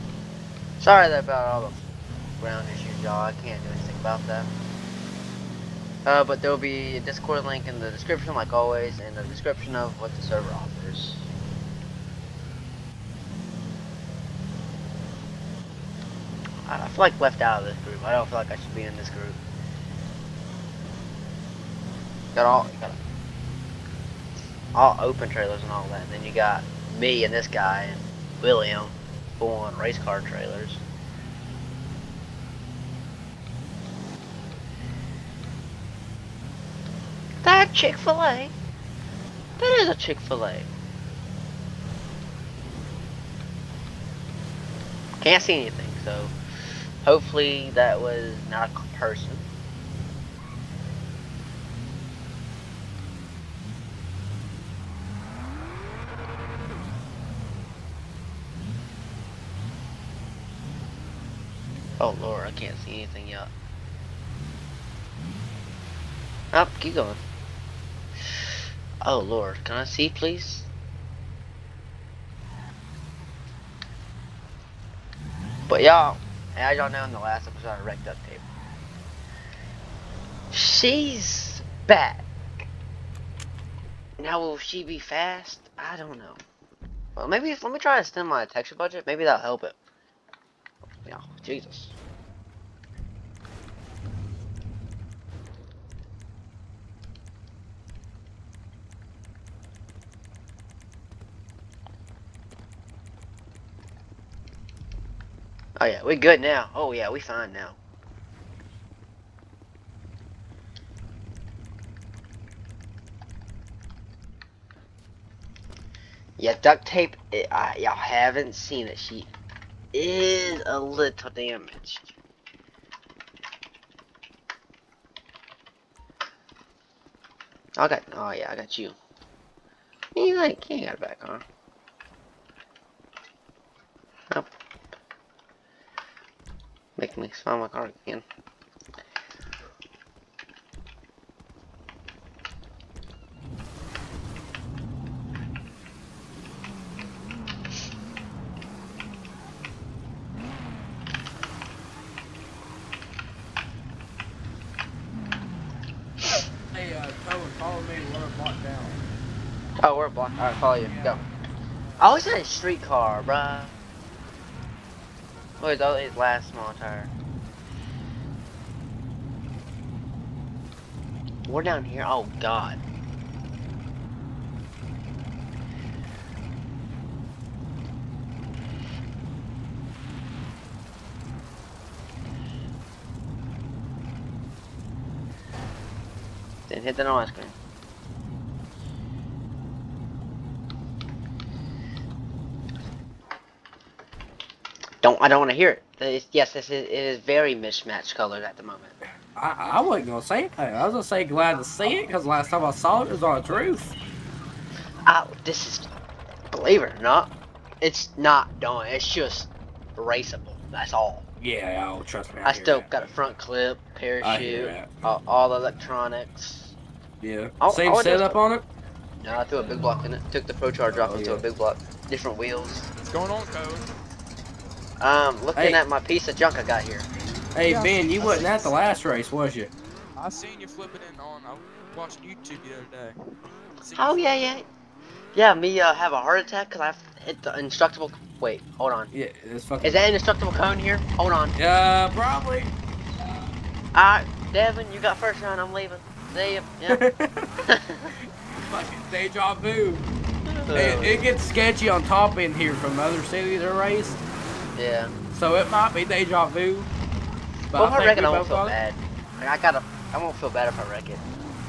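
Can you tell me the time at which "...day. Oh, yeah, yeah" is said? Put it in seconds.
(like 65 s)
233 s.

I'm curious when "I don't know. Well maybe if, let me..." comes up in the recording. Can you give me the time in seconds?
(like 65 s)
85 s.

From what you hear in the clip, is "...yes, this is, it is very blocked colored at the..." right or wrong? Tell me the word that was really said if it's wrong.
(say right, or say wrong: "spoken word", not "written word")
wrong: "mismatched", not "blocked".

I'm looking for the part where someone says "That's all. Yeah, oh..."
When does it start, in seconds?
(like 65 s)
210 s.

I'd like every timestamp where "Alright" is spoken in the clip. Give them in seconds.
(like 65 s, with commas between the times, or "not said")
160 s, 243 s.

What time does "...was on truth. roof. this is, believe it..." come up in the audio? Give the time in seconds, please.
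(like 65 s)
203 s.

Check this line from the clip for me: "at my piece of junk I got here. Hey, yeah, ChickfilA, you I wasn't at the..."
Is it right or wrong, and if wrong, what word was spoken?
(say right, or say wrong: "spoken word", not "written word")
wrong: "Ben", not "ChickfilA".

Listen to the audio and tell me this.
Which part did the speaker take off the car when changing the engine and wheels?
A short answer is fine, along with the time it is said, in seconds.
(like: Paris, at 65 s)
ProCharger, at 220 s.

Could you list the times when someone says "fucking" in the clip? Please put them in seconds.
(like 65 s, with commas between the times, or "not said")
239 s, 248 s.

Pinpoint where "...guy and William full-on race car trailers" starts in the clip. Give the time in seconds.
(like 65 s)
27 s.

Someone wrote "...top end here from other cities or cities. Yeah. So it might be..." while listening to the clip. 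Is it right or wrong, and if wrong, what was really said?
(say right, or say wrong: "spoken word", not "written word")
wrong: "races", not "cities".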